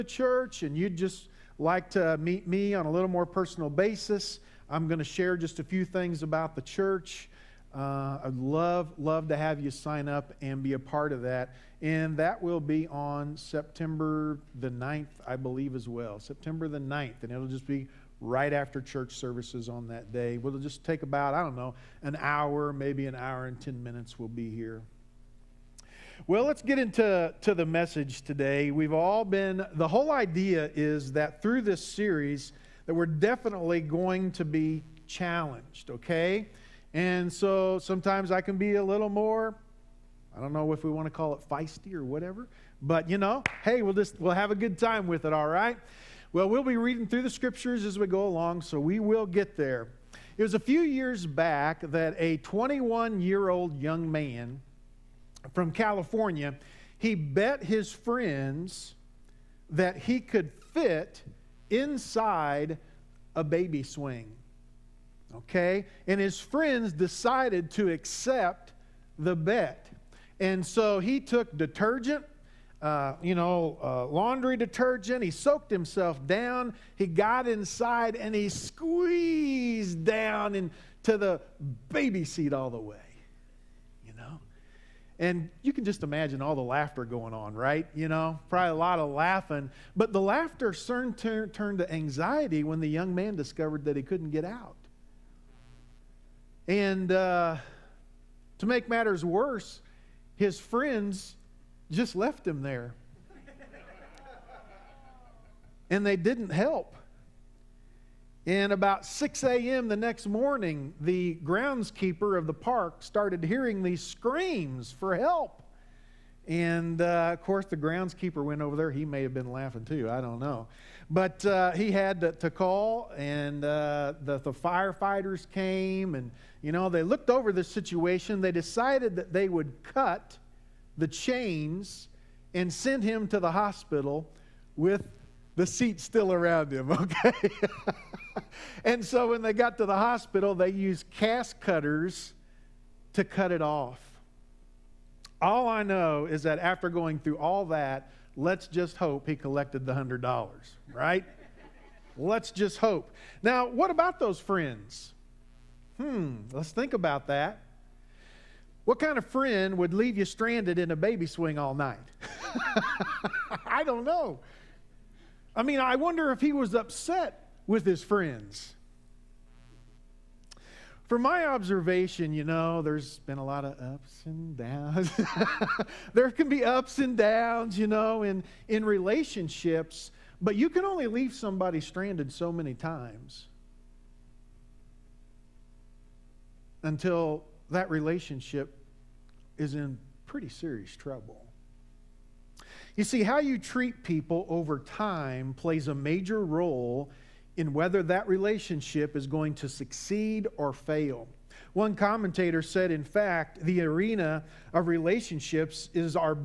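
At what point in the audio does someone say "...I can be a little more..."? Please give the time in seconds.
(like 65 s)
38 s.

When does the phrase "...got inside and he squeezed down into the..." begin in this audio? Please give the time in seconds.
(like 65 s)
77 s.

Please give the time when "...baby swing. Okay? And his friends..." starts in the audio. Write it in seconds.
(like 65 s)
63 s.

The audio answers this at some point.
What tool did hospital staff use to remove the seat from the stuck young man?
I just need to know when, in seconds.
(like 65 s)
141 s.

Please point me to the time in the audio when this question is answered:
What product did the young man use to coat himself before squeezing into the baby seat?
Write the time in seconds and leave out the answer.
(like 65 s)
74 s.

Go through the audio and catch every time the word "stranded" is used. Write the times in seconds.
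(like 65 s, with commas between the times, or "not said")
160 s, 181 s.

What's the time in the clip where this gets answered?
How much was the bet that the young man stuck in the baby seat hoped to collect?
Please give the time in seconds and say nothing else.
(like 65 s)
149 s.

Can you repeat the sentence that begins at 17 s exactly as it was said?
And it'll just be right after church services on that day.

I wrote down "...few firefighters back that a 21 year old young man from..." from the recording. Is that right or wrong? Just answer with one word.
wrong.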